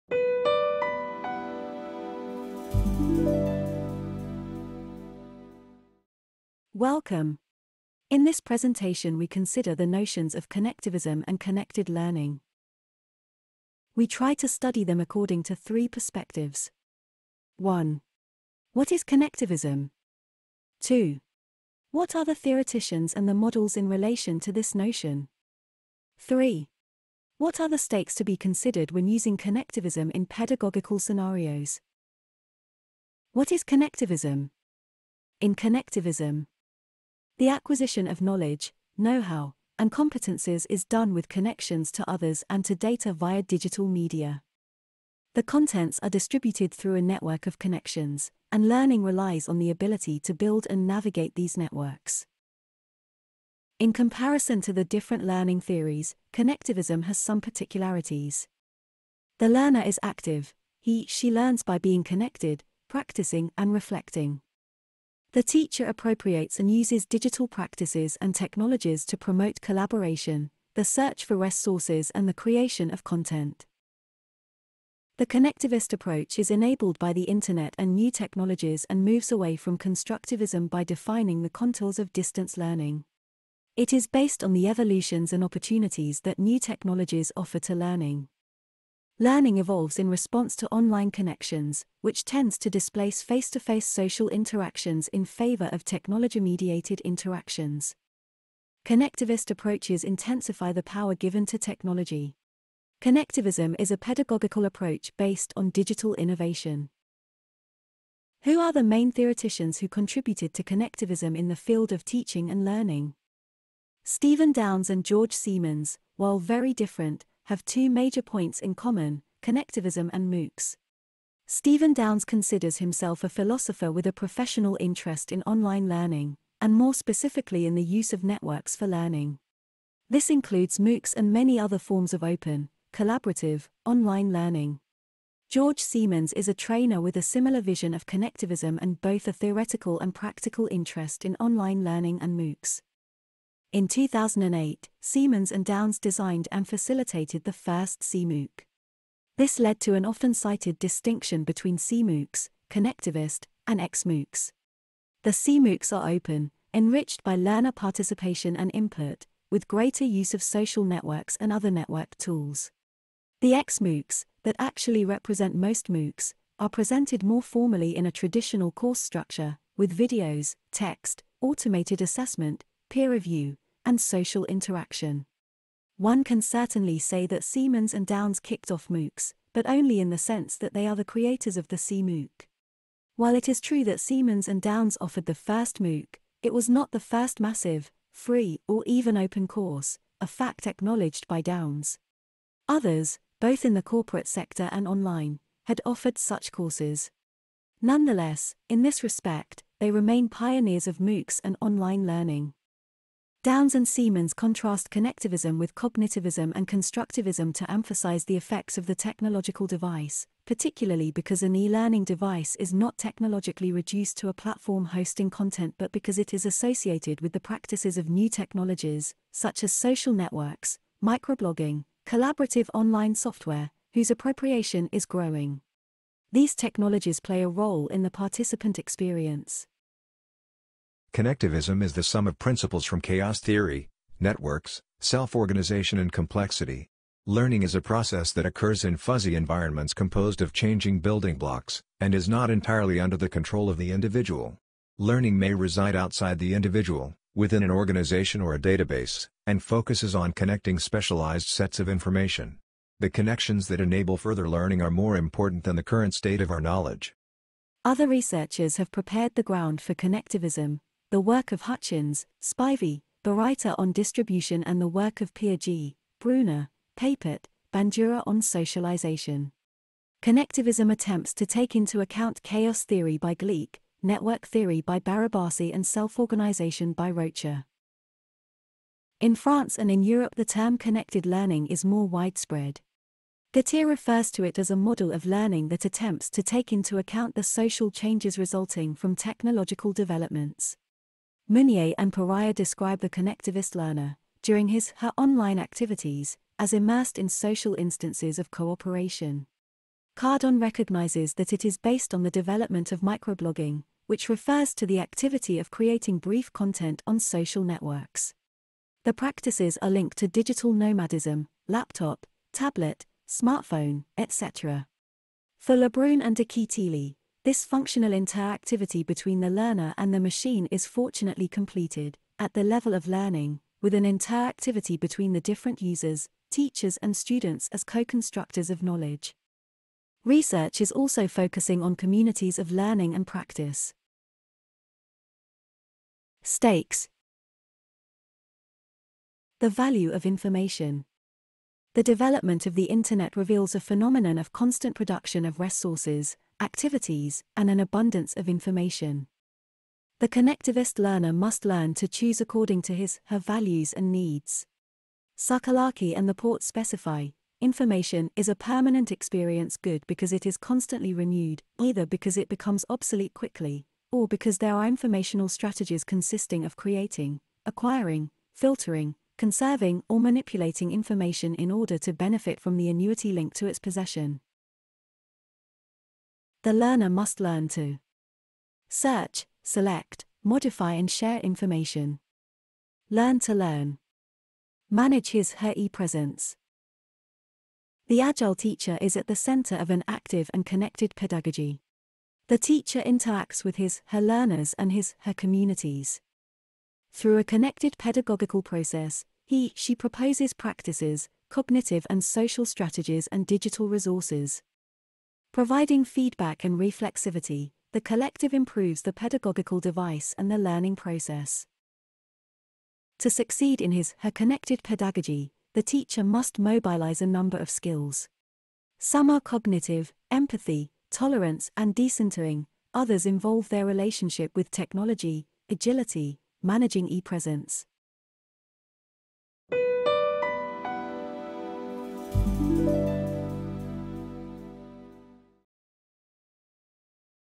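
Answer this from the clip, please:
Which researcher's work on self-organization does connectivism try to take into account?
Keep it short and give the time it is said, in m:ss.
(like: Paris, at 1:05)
Rocha, at 4:37.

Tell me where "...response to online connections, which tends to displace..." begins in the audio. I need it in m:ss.
1:30.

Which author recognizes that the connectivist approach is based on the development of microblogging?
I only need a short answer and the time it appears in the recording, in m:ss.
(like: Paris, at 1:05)
Cardon, at 5:00.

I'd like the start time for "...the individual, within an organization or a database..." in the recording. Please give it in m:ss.
4:06.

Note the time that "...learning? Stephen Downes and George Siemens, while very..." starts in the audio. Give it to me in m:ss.
1:52.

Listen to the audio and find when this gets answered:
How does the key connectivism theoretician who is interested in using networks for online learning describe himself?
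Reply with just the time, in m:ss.
2:03.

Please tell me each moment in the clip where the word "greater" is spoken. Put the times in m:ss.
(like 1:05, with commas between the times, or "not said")
2:39.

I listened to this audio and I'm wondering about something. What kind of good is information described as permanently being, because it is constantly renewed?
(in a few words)
Experience good.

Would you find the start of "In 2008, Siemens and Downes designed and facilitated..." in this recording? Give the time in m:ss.
2:23.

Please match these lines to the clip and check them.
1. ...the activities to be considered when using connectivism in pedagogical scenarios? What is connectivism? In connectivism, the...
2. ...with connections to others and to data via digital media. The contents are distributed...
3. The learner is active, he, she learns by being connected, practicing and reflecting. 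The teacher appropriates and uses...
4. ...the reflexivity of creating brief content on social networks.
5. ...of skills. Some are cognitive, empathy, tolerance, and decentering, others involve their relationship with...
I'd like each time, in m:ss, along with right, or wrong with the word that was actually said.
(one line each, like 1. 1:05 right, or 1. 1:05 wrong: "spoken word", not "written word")
1. 0:27 wrong: "stakes", not "activities"
2. 0:41 right
3. 0:59 right
4. 5:04 wrong: "activity", not "reflexivity"
5. 6:57 right.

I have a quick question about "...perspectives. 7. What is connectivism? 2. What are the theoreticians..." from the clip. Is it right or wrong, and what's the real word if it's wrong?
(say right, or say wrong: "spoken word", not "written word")
wrong: "1", not "7".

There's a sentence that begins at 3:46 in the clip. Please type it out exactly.
These technologies play a role in the participant experience.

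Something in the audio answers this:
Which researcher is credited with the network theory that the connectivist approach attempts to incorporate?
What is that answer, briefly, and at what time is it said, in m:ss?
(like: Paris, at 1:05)
Barabasi, at 4:35.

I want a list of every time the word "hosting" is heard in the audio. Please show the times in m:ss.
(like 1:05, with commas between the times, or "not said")
3:34.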